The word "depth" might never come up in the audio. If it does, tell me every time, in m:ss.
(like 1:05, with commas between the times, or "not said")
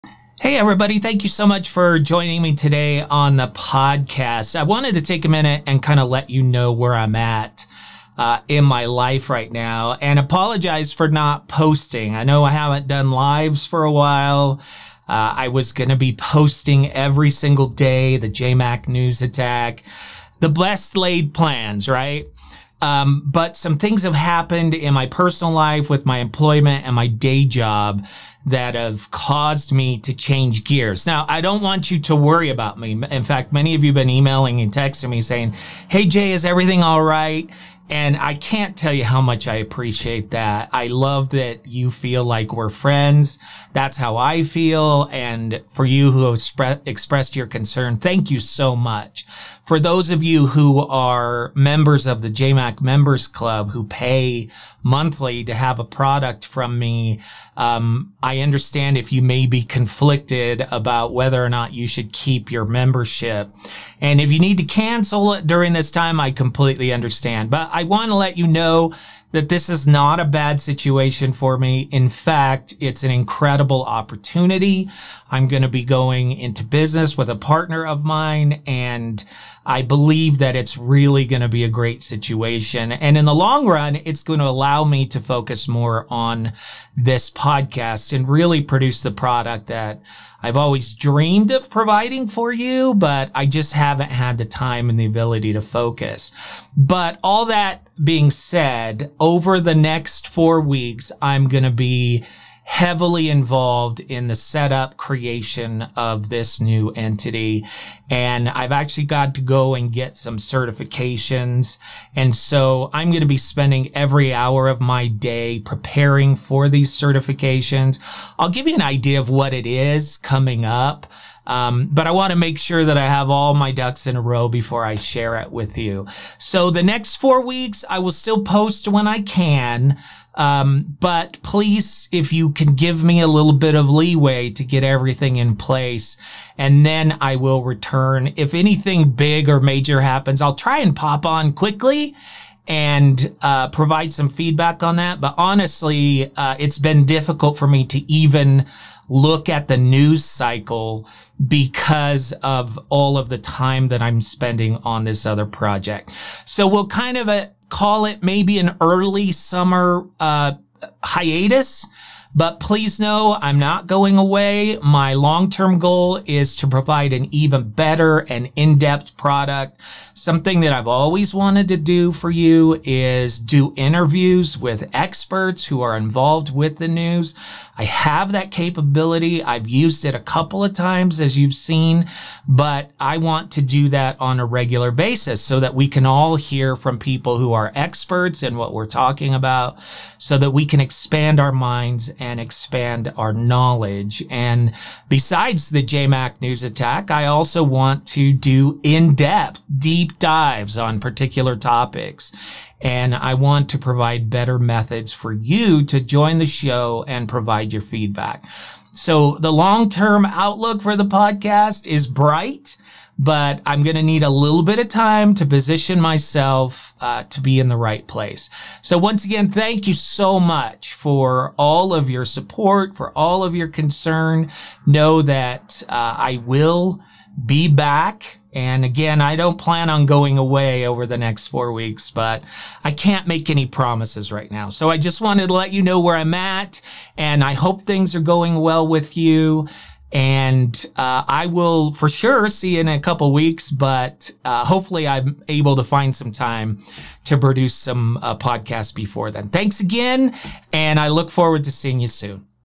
2:48, 3:18.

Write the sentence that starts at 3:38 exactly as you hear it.
So once again, thank you so much for all of your support, for all of your concern.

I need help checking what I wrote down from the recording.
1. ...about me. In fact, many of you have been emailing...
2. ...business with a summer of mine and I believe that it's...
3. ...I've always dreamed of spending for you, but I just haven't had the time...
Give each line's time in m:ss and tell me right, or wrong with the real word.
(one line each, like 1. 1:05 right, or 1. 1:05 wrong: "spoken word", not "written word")
1. 0:32 right
2. 1:16 wrong: "partner", not "summer"
3. 1:30 wrong: "providing", not "spending".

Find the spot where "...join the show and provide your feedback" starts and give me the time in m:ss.
3:25.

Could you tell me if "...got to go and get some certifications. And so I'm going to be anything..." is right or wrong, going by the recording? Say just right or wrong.
wrong.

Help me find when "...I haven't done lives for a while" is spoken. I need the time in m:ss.
0:12.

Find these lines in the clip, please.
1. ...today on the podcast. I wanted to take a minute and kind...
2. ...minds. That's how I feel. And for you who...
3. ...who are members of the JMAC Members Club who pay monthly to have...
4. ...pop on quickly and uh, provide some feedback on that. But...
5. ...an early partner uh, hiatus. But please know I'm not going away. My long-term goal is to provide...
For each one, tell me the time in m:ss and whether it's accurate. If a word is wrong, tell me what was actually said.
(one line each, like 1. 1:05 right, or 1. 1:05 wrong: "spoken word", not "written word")
1. 0:02 right
2. 0:42 wrong: "friends", not "minds"
3. 0:50 right
4. 2:20 right
5. 2:38 wrong: "summer", not "partner".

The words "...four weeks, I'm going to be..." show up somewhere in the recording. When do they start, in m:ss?
1:40.